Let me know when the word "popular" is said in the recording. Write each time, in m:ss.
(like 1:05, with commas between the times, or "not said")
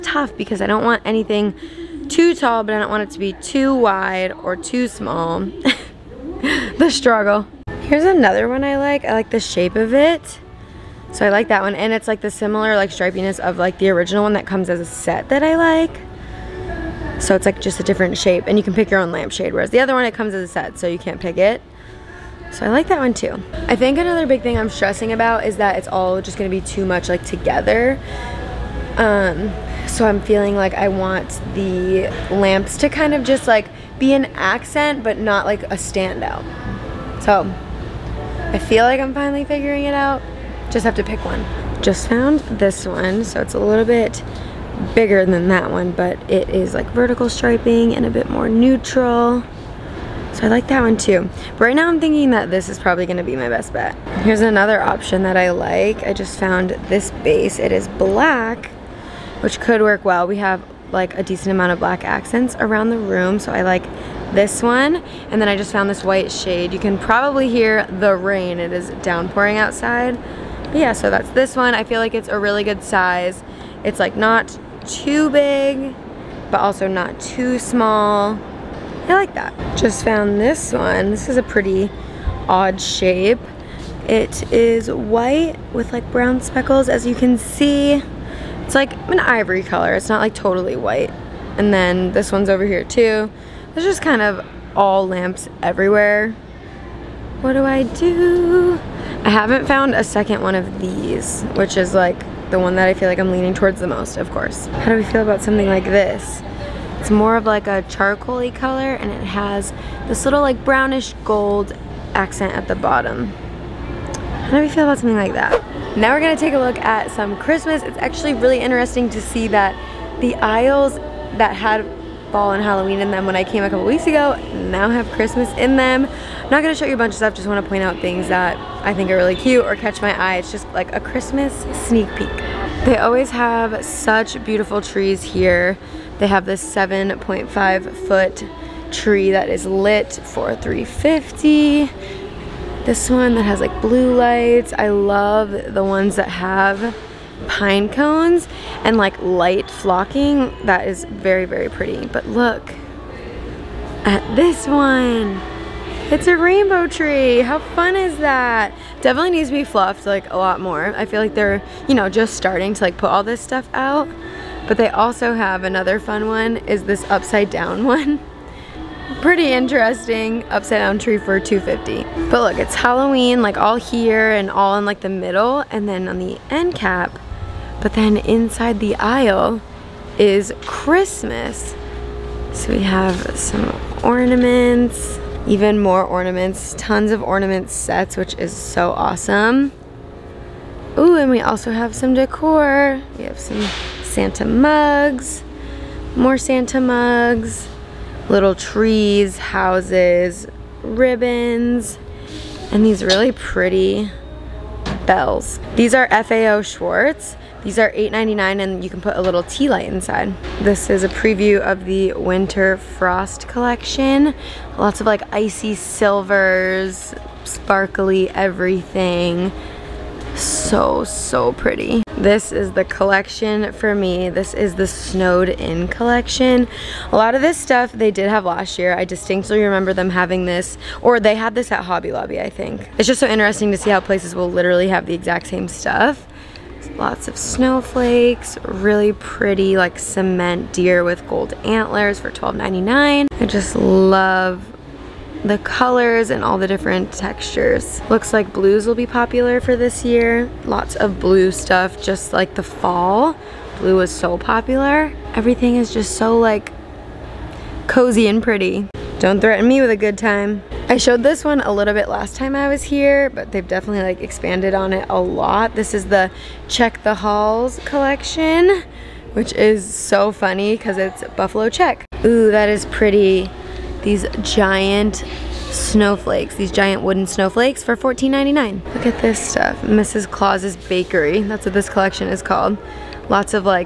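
4:09, 4:14.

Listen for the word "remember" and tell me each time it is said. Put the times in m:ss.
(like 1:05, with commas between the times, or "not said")
3:49.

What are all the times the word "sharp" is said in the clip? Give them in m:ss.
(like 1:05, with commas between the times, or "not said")
not said.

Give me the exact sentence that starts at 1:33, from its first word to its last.
There's just kind of all lamps everywhere.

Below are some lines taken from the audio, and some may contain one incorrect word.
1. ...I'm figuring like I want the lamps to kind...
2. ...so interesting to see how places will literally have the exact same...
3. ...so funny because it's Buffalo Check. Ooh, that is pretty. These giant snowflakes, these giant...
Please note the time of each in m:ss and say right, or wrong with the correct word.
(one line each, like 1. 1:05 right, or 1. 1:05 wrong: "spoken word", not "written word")
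1. 0:30 wrong: "feeling", not "figuring"
2. 3:53 right
3. 4:29 right.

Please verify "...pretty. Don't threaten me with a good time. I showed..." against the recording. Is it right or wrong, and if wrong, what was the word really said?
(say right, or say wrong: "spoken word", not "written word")
right.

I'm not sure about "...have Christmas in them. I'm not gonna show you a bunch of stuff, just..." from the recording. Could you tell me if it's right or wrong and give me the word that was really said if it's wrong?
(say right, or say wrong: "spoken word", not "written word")
right.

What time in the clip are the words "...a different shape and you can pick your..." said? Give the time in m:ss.
0:17.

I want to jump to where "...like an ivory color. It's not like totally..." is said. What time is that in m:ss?
1:28.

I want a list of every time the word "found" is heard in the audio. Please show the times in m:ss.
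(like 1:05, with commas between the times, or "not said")
0:42, 0:56, 1:05, 1:20, 1:39.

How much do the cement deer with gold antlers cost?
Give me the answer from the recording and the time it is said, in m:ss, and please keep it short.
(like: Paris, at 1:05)
$12.99, at 4:02.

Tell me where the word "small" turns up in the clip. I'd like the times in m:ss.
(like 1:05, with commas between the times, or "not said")
0:04, 1:17.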